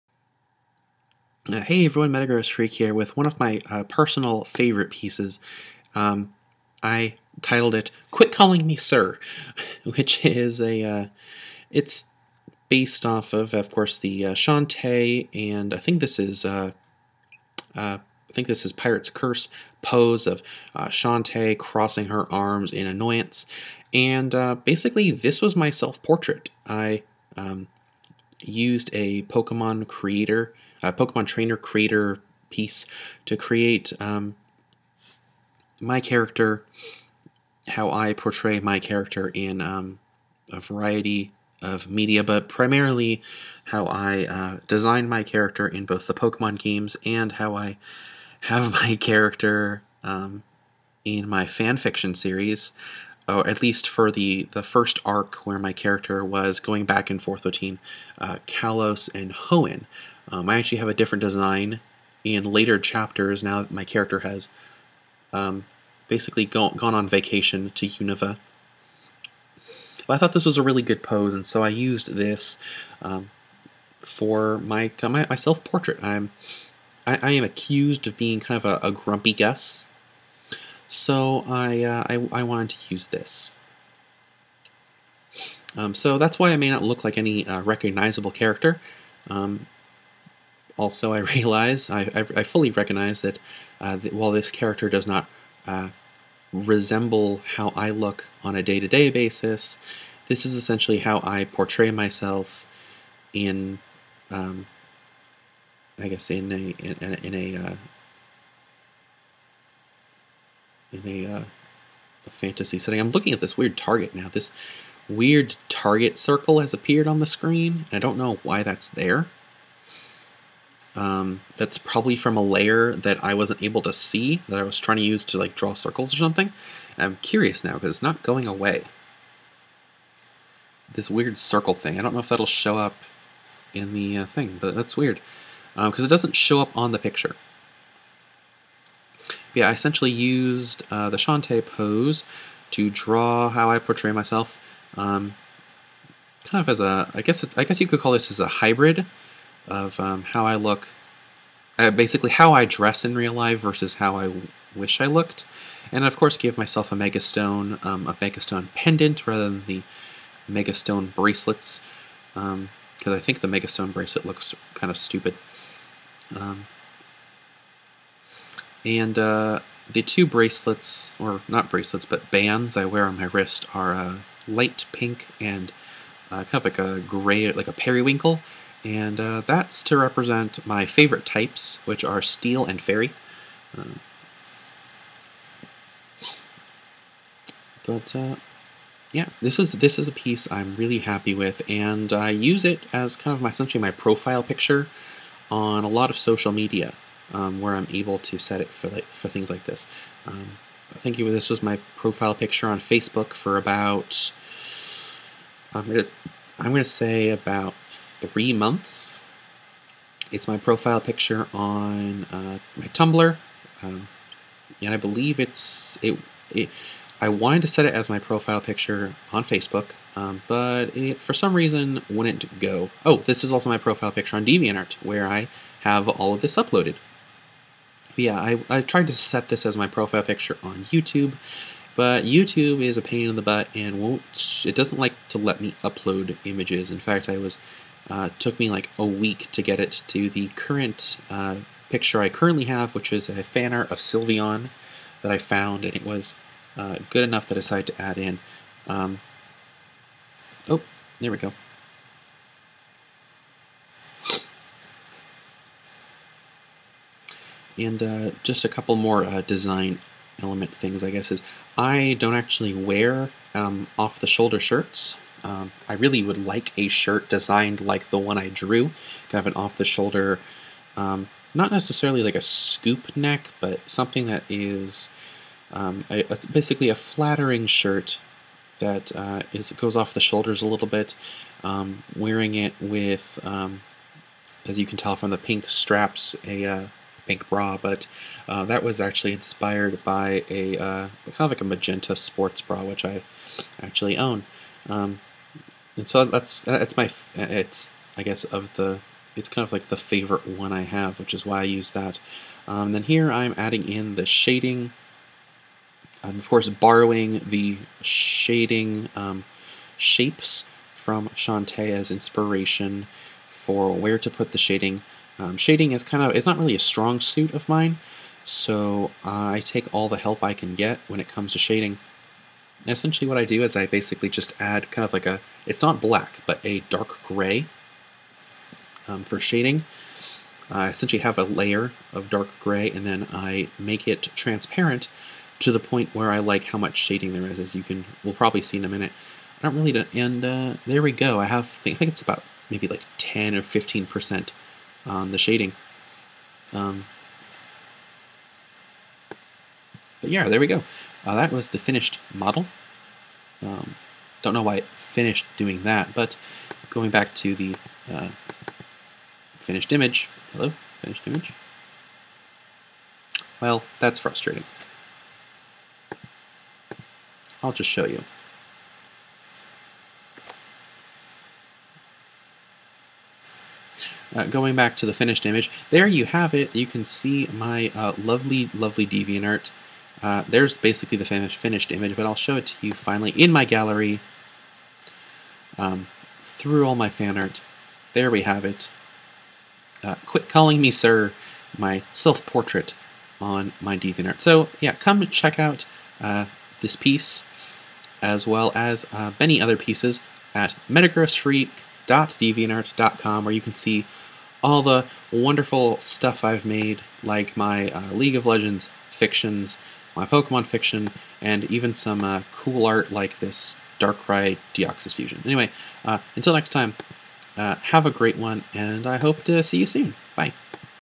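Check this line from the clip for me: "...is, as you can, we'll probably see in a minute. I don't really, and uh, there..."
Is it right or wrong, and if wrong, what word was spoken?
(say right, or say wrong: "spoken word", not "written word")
right.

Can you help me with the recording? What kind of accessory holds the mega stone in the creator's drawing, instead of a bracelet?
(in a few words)
Pendant.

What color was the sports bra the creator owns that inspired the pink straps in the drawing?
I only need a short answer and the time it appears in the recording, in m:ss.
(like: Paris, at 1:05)
Magenta, at 4:51.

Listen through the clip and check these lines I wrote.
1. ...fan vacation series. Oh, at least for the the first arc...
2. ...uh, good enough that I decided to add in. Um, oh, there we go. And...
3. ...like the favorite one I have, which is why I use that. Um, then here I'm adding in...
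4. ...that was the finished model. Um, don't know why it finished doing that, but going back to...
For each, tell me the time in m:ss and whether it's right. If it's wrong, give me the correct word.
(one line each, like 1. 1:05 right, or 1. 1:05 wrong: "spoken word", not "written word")
1. 0:51 wrong: "fiction", not "vacation"
2. 4:06 right
3. 4:59 right
4. 5:51 right.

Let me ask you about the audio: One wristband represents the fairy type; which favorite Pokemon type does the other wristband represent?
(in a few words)
Steel.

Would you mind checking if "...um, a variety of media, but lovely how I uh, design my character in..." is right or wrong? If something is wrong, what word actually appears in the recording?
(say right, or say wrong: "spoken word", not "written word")
wrong: "primarily", not "lovely".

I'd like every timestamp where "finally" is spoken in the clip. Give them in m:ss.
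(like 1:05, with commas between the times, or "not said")
6:22.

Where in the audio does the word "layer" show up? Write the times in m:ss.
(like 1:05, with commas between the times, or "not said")
2:02, 5:31.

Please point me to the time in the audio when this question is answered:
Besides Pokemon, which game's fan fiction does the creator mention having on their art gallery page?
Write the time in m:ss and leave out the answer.
6:48.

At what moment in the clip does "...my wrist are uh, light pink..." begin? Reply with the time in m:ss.
2:53.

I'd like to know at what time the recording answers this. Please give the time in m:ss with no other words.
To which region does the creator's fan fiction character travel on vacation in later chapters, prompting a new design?
1:07.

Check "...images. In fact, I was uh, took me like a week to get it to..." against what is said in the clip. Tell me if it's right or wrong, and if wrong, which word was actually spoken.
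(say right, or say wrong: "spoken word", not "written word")
right.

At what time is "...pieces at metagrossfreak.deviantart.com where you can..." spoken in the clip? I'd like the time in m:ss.
6:39.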